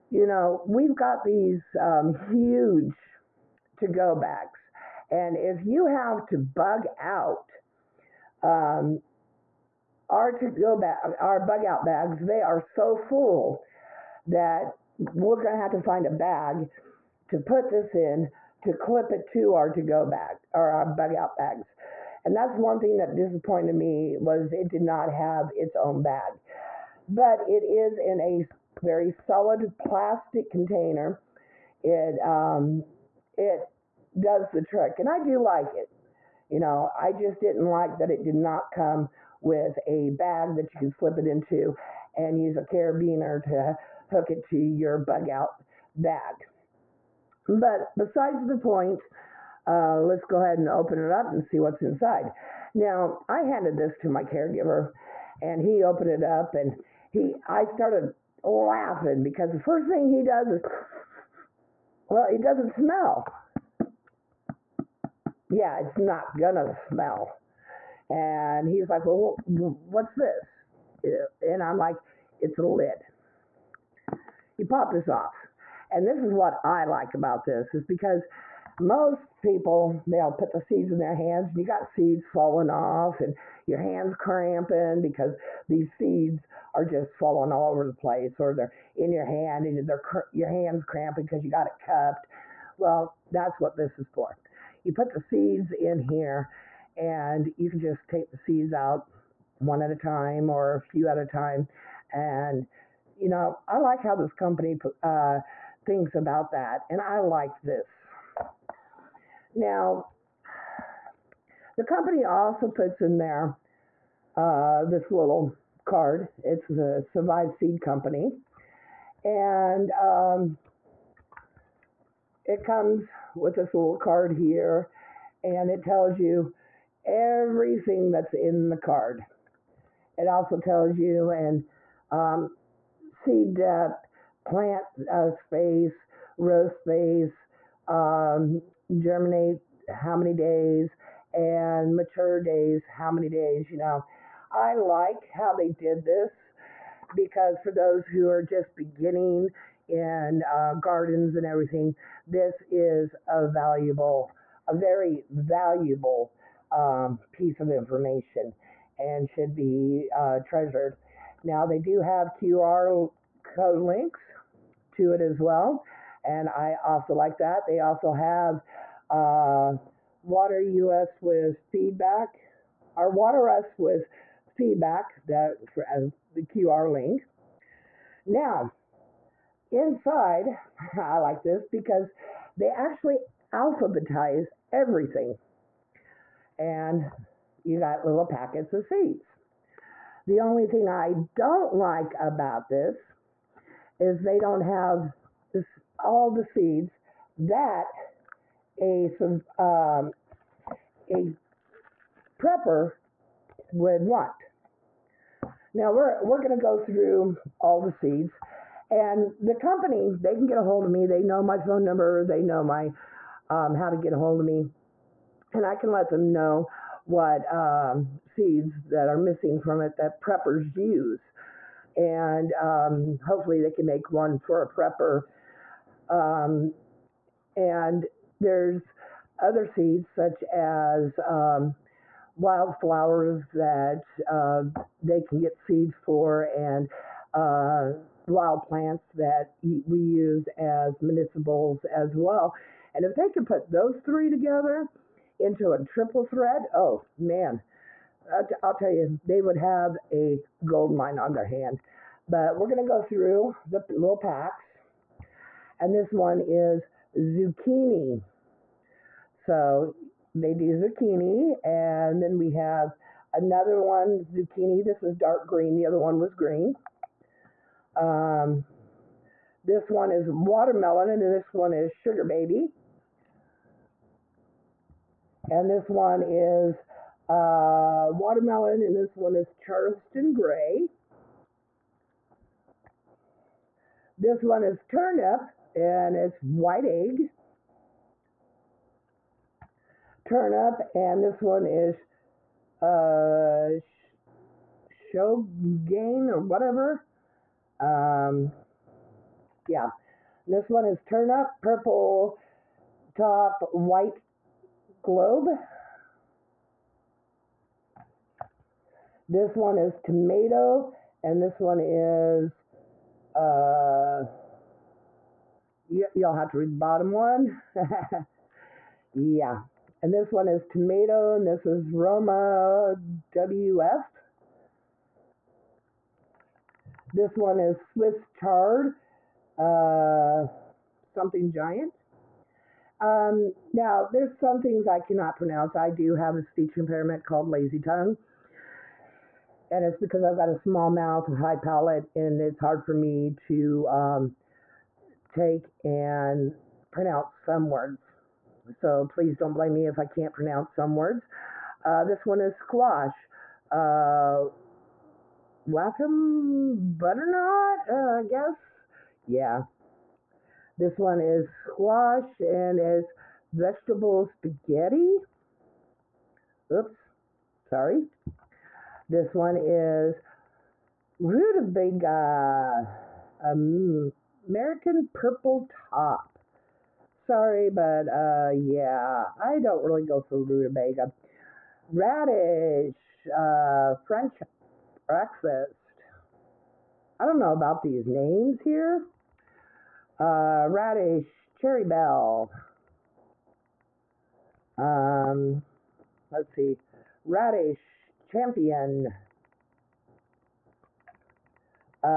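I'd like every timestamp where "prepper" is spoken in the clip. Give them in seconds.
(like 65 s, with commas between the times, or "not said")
202 s, 220 s, 224 s.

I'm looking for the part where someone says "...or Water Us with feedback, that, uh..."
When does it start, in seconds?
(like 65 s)
172 s.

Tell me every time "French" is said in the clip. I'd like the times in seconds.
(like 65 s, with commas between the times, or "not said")
384 s.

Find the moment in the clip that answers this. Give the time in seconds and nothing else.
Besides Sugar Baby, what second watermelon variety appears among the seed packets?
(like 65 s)
279 s.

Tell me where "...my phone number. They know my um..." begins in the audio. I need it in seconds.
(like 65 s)
211 s.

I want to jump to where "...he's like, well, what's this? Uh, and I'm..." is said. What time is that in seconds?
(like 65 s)
68 s.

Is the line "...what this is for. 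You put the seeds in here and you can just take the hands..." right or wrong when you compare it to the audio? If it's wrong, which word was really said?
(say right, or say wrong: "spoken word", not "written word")
wrong: "seeds", not "hands".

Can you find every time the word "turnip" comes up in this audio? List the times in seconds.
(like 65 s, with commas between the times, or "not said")
284 s, 290 s, 301 s.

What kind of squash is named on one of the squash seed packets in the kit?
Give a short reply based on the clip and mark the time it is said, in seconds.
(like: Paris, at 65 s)
Vegetable spaghetti, at 363 s.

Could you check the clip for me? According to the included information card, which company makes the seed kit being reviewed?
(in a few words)
Survive Seed Company.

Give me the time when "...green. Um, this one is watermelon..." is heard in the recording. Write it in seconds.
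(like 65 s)
266 s.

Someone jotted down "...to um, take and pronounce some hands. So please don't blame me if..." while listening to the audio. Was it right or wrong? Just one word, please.
wrong.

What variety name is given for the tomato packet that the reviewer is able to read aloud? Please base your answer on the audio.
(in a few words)
Roma WF.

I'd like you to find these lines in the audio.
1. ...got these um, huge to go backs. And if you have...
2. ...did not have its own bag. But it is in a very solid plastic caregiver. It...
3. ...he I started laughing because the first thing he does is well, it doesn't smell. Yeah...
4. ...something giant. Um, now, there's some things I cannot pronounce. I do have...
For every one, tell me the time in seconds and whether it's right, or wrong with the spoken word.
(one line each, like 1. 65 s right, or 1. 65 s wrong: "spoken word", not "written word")
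1. 0 s right
2. 24 s wrong: "container", not "caregiver"
3. 57 s right
4. 331 s right.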